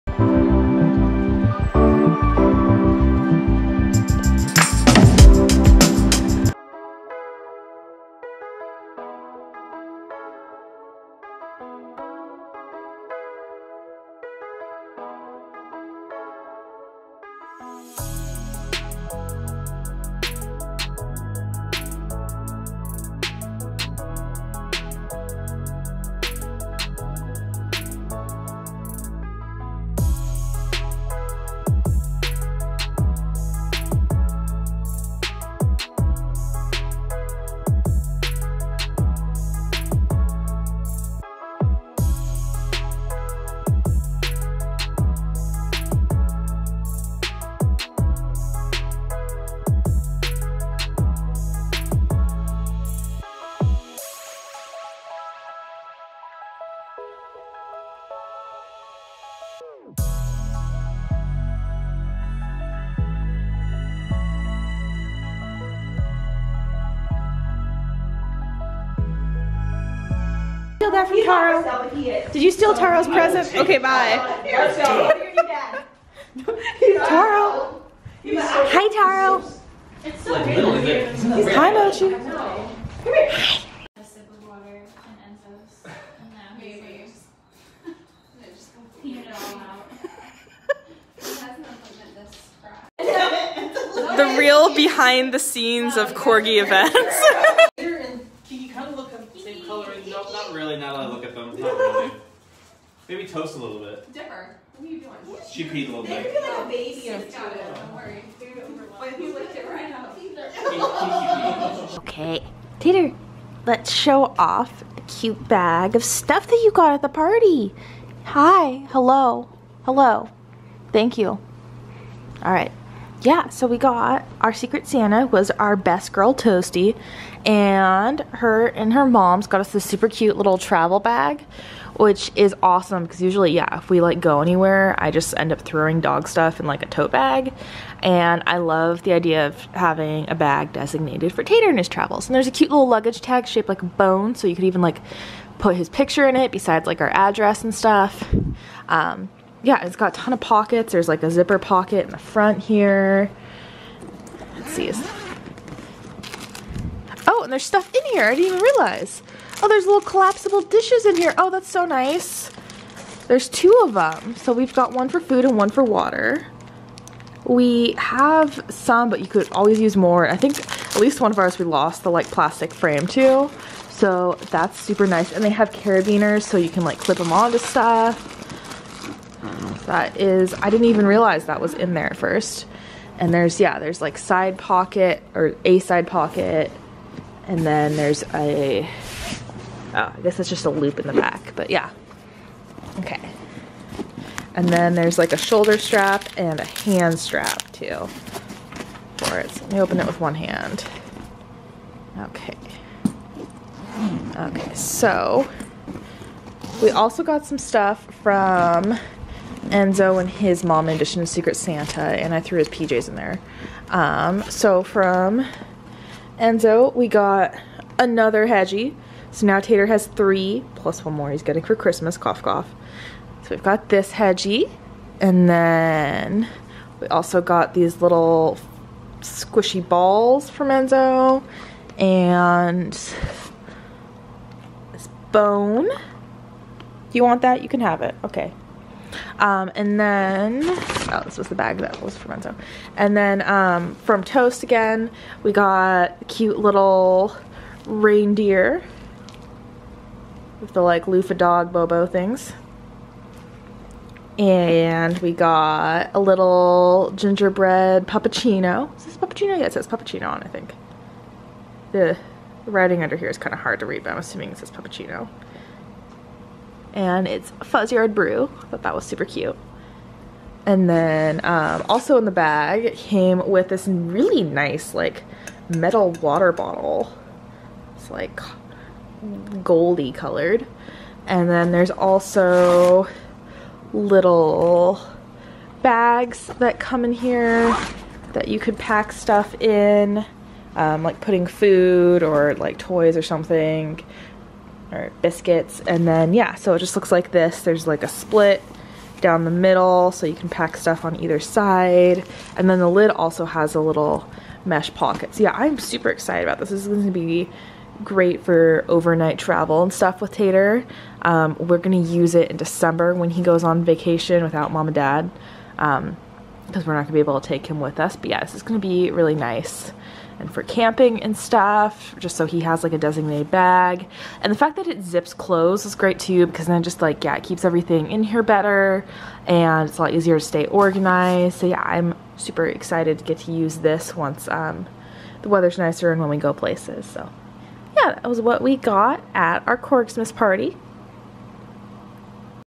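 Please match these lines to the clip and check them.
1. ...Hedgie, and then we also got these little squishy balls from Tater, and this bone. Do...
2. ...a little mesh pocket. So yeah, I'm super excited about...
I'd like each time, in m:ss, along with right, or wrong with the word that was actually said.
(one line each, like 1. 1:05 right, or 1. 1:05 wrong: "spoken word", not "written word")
1. 3:44 wrong: "Enzo", not "Tater"
2. 5:03 right.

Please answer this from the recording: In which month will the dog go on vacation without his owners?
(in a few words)
December.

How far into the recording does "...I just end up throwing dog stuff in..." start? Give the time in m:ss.
2:14.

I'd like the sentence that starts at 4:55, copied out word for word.
And then, yeah, so it just looks like this.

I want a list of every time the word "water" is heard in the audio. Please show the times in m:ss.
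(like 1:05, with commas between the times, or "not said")
1:24, 2:45, 4:36.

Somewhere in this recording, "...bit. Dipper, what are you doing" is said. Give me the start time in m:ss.
1:43.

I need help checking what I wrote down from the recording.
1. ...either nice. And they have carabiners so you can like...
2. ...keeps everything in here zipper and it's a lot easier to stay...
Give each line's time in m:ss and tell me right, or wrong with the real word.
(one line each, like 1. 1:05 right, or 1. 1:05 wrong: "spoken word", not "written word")
1. 2:54 wrong: "super", not "either"
2. 5:27 wrong: "better", not "zipper".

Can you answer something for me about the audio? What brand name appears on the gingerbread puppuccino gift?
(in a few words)
Fuzz Yard Brew.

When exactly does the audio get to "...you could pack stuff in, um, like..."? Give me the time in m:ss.
4:48.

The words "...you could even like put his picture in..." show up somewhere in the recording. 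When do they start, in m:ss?
2:24.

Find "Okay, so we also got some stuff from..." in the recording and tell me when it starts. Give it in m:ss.
3:24.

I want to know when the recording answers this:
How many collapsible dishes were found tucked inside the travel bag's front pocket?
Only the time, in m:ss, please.
2:43.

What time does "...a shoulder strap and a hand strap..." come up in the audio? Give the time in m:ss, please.
3:15.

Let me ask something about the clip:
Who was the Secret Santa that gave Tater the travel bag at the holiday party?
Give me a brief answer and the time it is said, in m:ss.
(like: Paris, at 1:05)
Toasty, at 2:06.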